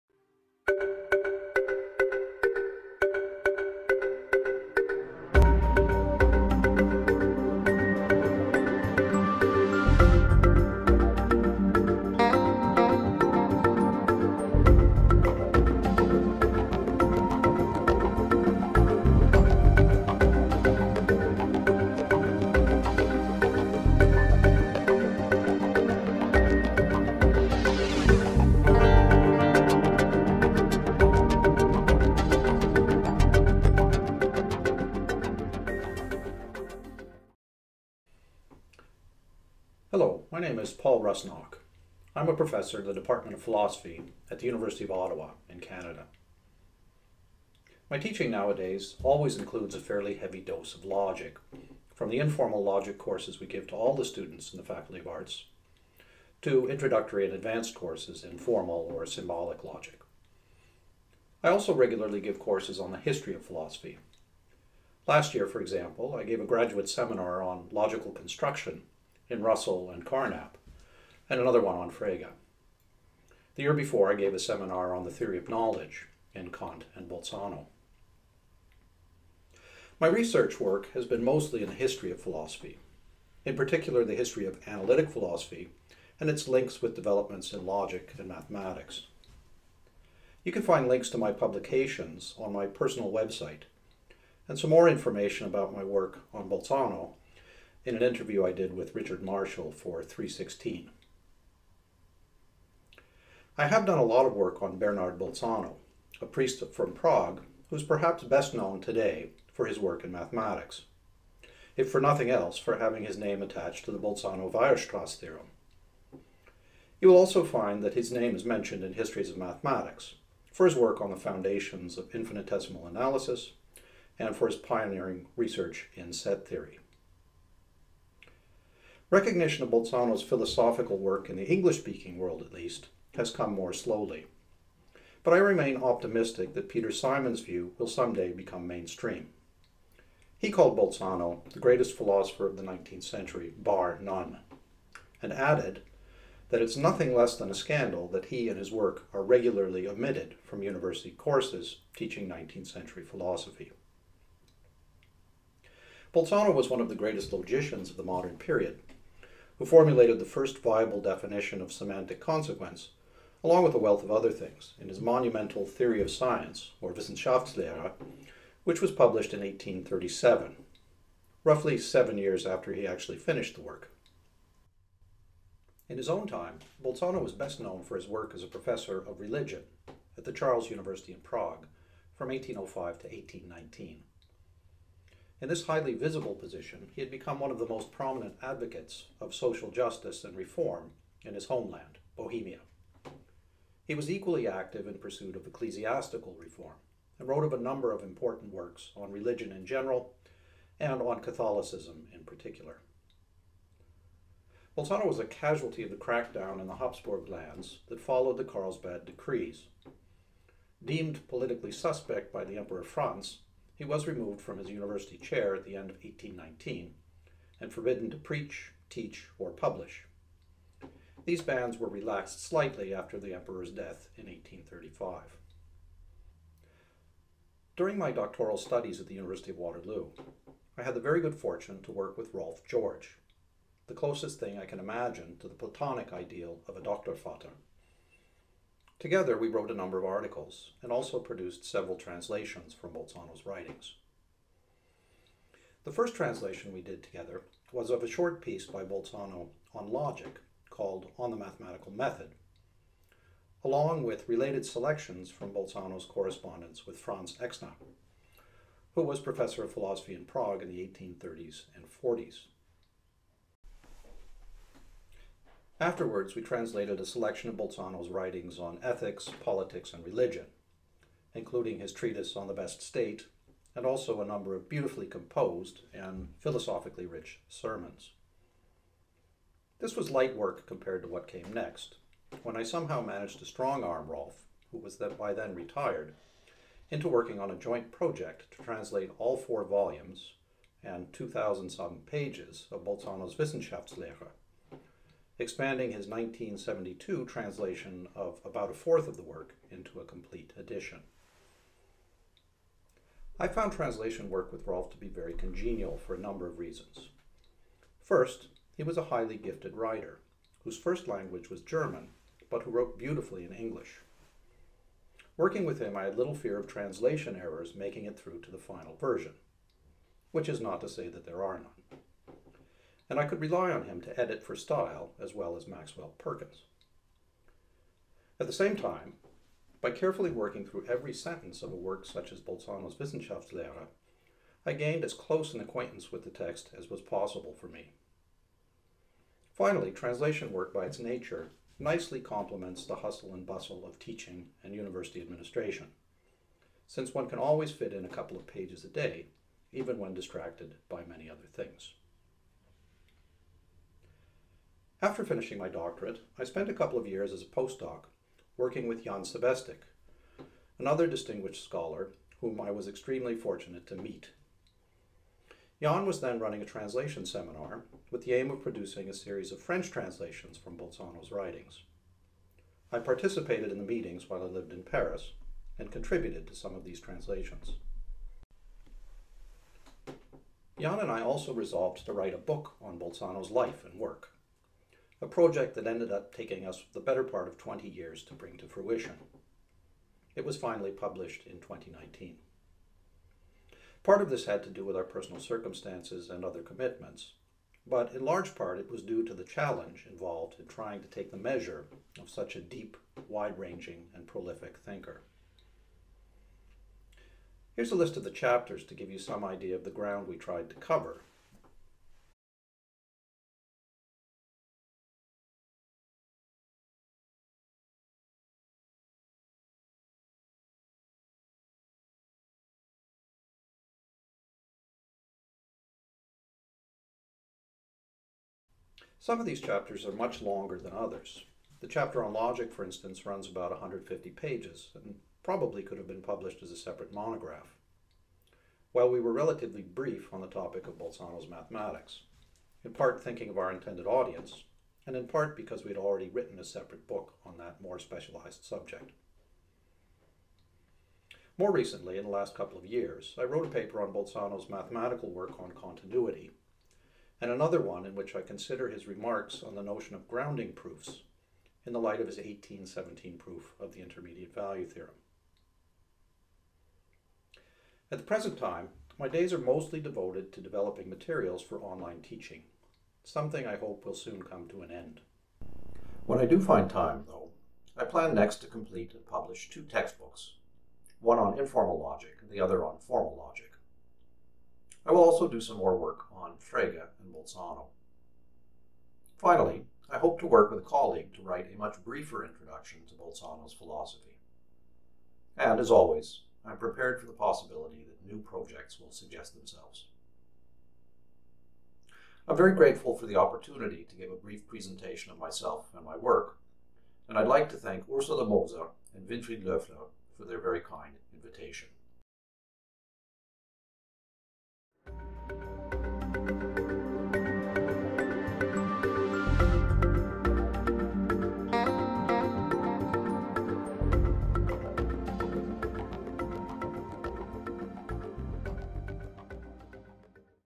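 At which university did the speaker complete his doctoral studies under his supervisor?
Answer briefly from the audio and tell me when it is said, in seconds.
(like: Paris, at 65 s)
University of Waterloo, at 229 s.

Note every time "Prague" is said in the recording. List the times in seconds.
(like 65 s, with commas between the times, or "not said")
106 s, 181 s, 260 s.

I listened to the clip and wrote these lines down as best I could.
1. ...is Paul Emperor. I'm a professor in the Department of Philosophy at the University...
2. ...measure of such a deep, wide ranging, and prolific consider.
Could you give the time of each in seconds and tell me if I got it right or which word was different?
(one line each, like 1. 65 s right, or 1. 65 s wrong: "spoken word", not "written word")
1. 40 s wrong: "Rusnock", not "Emperor"
2. 401 s wrong: "thinker", not "consider".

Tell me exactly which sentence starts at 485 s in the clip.
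I will also do some more work on Frege and Bolzano.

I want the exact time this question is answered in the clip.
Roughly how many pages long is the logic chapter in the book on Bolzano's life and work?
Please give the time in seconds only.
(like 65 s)
433 s.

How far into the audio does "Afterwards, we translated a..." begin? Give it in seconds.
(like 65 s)
265 s.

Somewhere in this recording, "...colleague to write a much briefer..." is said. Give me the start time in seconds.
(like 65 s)
490 s.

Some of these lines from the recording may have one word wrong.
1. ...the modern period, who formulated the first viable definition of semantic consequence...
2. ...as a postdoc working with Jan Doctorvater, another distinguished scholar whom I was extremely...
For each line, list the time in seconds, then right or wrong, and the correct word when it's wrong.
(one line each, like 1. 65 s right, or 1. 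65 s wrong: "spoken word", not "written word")
1. 157 s right
2. 357 s wrong: "Sebestik", not "Doctorvater".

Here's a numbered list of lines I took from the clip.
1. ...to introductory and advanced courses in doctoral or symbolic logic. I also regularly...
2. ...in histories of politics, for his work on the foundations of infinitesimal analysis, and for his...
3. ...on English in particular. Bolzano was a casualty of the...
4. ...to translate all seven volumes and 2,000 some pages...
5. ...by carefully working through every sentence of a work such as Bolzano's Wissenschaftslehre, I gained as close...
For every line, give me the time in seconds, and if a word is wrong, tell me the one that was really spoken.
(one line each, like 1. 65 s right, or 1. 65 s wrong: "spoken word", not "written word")
1. 56 s wrong: "formal", not "doctoral"
2. 118 s wrong: "mathematics", not "politics"
3. 201 s wrong: "Catholicism", not "English"
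4. 288 s wrong: "four", not "seven"
5. 329 s right.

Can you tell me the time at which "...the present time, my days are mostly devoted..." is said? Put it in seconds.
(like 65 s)
468 s.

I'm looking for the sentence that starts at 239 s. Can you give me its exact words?
Together, we wrote a number of articles and also produced several translations from Bolzano's writings.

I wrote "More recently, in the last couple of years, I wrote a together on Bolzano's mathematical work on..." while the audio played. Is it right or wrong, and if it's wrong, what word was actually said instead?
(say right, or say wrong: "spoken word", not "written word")
wrong: "paper", not "together".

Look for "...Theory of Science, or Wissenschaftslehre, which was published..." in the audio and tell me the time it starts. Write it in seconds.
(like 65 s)
165 s.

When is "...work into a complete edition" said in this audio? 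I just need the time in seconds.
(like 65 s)
299 s.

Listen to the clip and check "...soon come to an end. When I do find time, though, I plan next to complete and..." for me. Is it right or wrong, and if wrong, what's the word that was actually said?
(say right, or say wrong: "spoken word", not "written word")
right.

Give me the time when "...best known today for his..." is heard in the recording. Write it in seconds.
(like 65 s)
108 s.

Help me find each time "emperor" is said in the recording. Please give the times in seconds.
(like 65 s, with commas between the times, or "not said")
212 s, 223 s.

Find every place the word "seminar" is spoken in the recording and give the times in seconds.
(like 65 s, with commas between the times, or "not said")
66 s, 74 s, 367 s.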